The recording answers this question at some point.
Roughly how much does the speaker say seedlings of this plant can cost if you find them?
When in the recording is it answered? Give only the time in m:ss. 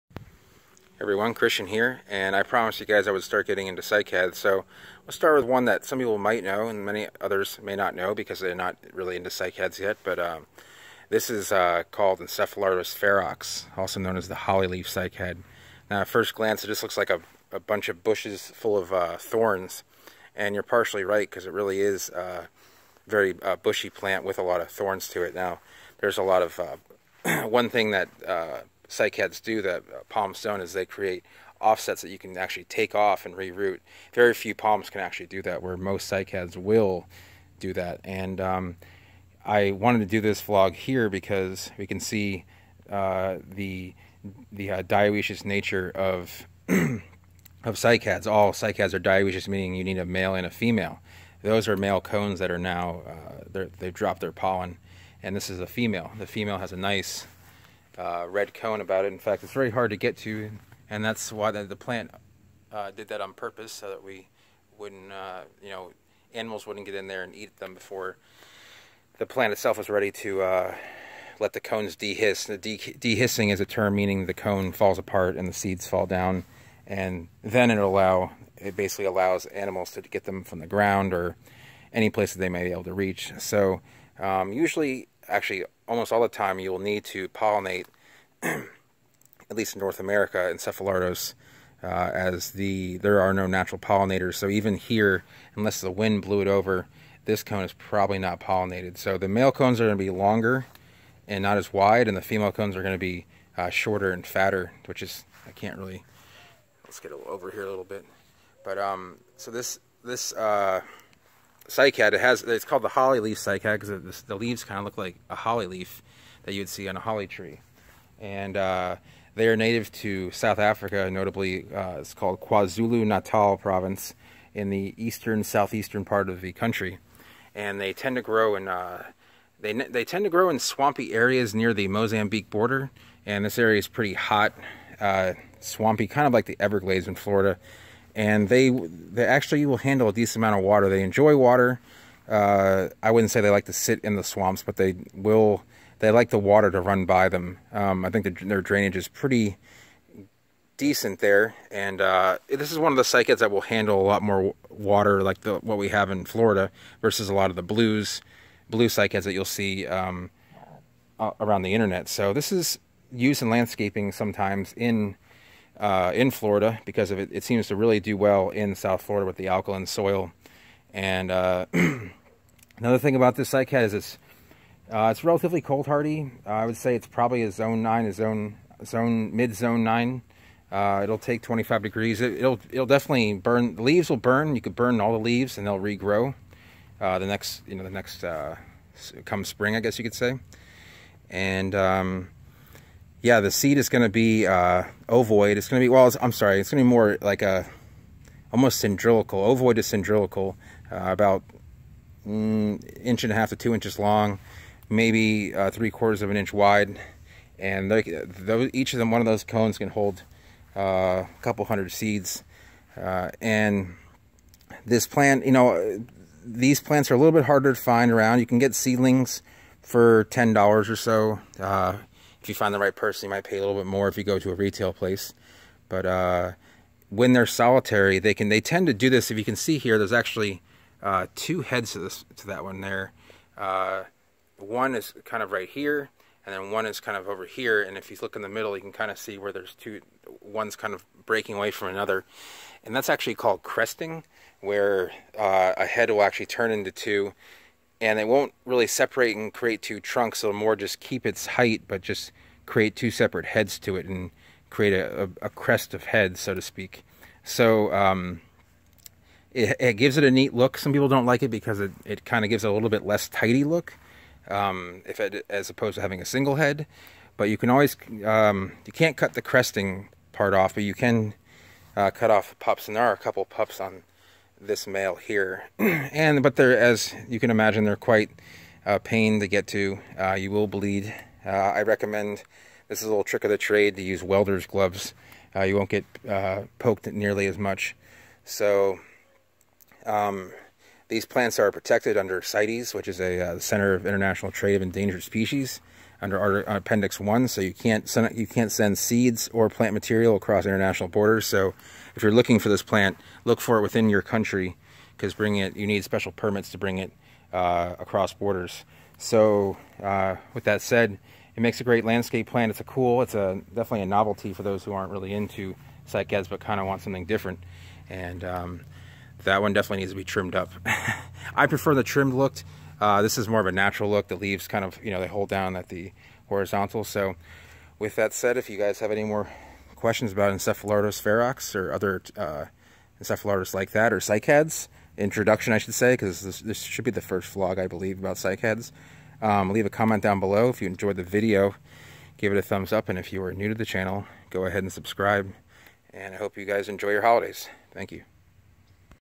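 3:40.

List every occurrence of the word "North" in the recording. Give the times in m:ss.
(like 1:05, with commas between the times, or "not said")
1:29.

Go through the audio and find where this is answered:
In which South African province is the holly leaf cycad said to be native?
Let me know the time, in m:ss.
2:02.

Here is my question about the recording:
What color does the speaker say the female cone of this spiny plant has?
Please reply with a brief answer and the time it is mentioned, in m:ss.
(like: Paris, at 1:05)
Red, at 0:58.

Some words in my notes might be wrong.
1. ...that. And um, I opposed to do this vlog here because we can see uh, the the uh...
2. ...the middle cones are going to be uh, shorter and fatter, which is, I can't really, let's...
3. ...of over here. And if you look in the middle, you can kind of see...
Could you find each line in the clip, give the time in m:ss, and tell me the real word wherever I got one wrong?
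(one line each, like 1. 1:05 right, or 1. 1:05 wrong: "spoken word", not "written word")
1. 0:37 wrong: "wanted", not "opposed"
2. 1:42 wrong: "female", not "middle"
3. 3:57 right.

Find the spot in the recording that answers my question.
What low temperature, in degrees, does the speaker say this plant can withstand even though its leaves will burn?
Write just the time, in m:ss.
3:01.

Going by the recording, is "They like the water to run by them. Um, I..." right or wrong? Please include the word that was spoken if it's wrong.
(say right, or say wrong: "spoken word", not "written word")
right.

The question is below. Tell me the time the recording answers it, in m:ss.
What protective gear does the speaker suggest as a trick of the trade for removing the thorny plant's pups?
4:44.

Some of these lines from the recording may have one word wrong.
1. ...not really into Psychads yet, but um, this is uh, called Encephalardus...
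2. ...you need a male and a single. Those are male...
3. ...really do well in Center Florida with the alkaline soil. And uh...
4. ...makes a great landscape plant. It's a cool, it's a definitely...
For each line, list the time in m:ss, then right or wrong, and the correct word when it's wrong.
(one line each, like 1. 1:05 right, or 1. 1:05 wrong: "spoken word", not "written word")
1. 0:08 right
2. 0:49 wrong: "female", not "single"
3. 2:47 wrong: "South", not "Center"
4. 5:11 right.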